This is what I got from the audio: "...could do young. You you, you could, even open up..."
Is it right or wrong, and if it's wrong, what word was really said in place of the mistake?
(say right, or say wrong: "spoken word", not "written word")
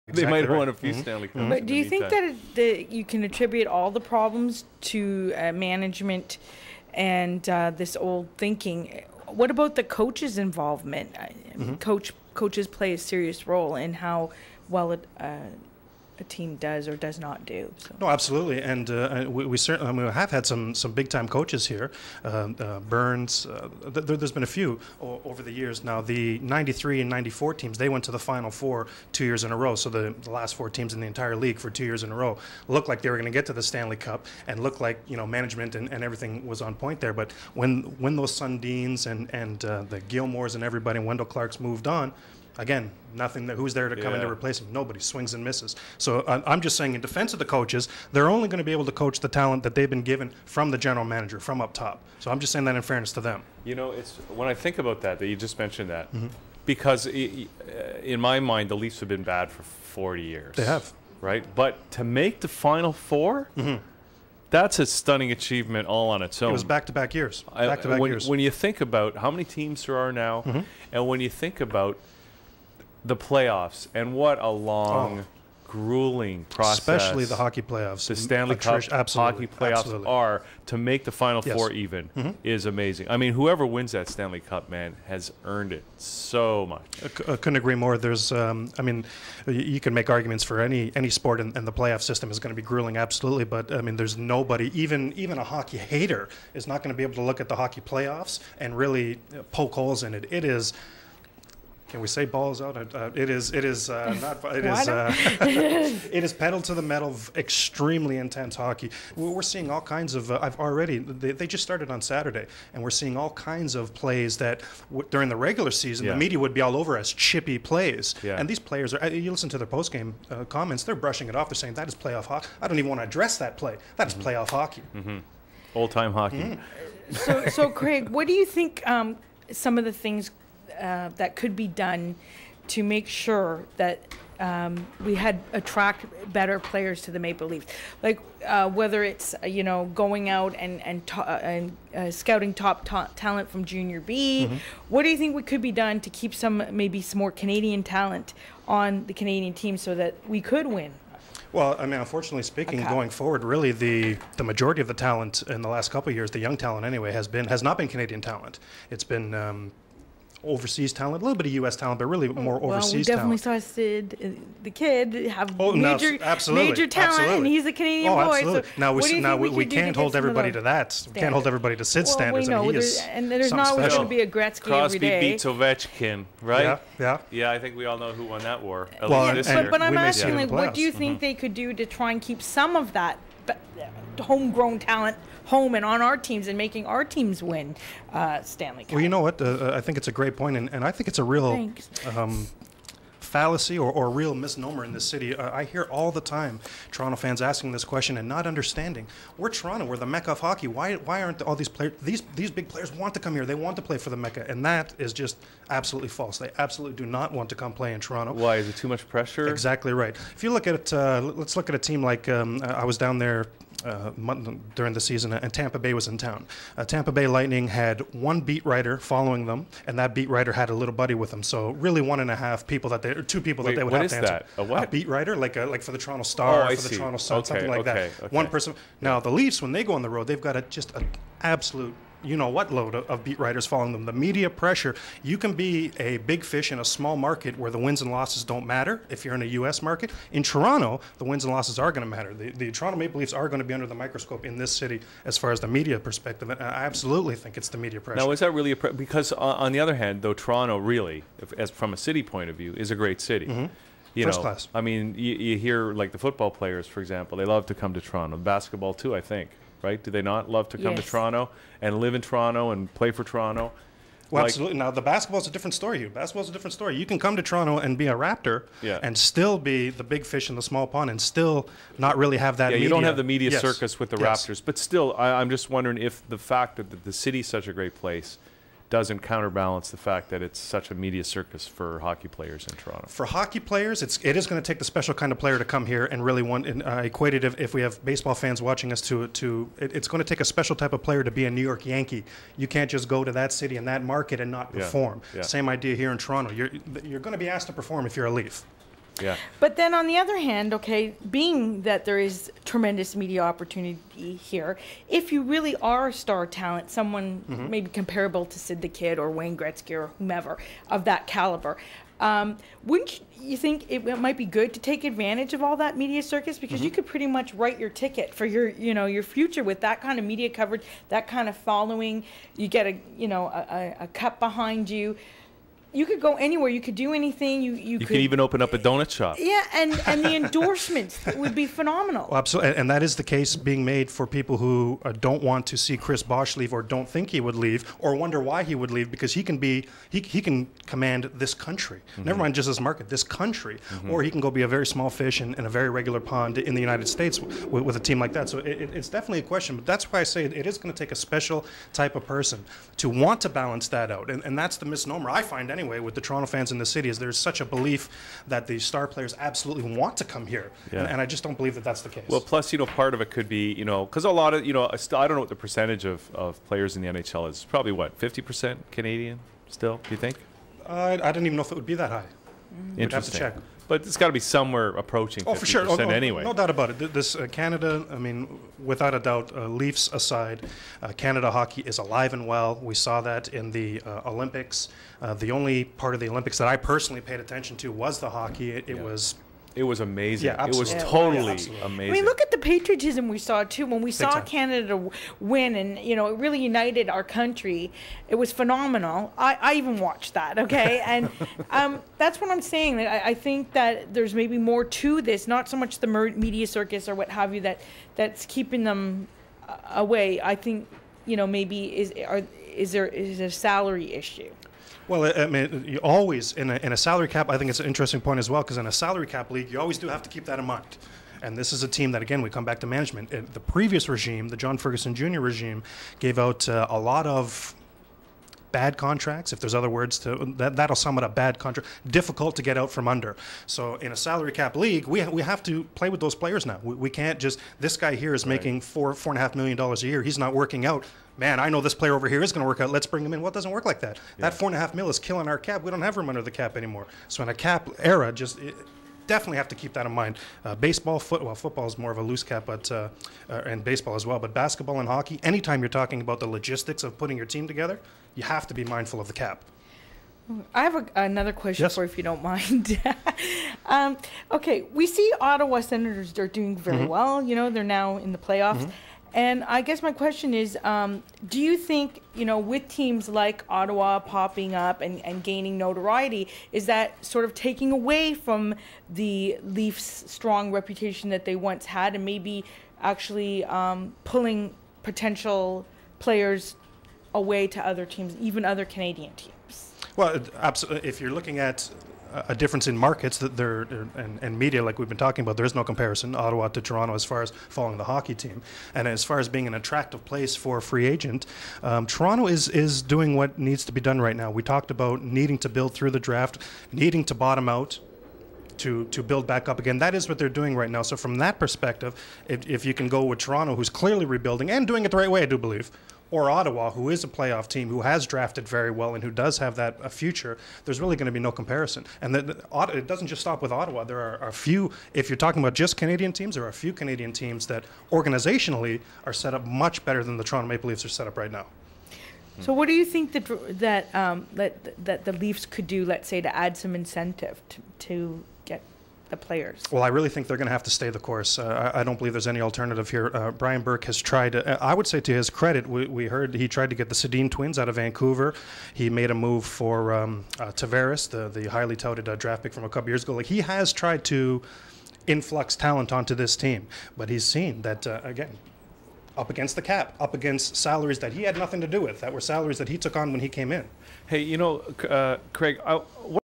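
wrong: "anything", not "young".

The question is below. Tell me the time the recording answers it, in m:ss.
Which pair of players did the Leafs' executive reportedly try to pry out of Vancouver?
9:07.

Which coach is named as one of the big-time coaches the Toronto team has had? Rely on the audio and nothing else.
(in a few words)
Burns.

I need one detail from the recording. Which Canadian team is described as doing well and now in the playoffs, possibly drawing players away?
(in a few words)
Ottawa Senators.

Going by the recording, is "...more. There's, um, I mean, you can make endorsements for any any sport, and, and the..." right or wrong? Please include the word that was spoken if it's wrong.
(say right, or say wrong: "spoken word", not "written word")
wrong: "arguments", not "endorsements".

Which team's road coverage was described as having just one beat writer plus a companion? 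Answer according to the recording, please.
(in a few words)
Tampa Bay Lightning.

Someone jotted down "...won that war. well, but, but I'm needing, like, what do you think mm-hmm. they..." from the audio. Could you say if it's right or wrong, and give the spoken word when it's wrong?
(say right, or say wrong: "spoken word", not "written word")
wrong: "asking", not "needing".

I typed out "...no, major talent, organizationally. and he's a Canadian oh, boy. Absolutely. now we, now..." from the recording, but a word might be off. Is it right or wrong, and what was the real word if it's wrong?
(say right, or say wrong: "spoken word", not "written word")
wrong: "absolutely", not "organizationally".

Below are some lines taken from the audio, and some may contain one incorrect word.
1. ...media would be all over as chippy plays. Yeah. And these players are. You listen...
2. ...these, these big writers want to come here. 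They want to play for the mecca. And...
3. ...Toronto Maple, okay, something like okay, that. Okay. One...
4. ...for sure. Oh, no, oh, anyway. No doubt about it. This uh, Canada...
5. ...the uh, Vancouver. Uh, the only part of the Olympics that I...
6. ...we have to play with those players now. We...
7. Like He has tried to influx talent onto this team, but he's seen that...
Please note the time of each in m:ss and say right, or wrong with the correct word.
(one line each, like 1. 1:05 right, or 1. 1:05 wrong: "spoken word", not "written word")
1. 1:56 right
2. 3:22 wrong: "players", not "writers"
3. 3:46 wrong: "Sun", not "Maple"
4. 6:15 right
5. 6:23 wrong: "Olympics", not "Vancouver"
6. 7:15 right
7. 9:13 right.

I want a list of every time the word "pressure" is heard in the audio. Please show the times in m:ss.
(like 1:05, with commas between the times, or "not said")
3:29, 3:54, 4:07.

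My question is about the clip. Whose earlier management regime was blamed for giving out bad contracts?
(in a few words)
John Ferguson Jr.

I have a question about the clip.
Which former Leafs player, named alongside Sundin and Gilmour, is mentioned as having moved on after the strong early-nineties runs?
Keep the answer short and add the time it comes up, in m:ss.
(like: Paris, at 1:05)
Wendell Clark, at 0:41.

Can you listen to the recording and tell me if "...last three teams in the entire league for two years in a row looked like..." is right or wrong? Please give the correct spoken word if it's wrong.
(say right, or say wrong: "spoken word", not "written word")
wrong: "four", not "three".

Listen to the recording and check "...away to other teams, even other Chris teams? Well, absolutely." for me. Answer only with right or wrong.
wrong.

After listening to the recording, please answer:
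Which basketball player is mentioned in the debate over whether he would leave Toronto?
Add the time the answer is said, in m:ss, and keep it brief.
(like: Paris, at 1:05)
Chris Bosh, at 5:35.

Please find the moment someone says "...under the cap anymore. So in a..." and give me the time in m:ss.
7:26.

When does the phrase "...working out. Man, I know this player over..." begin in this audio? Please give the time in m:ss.
7:20.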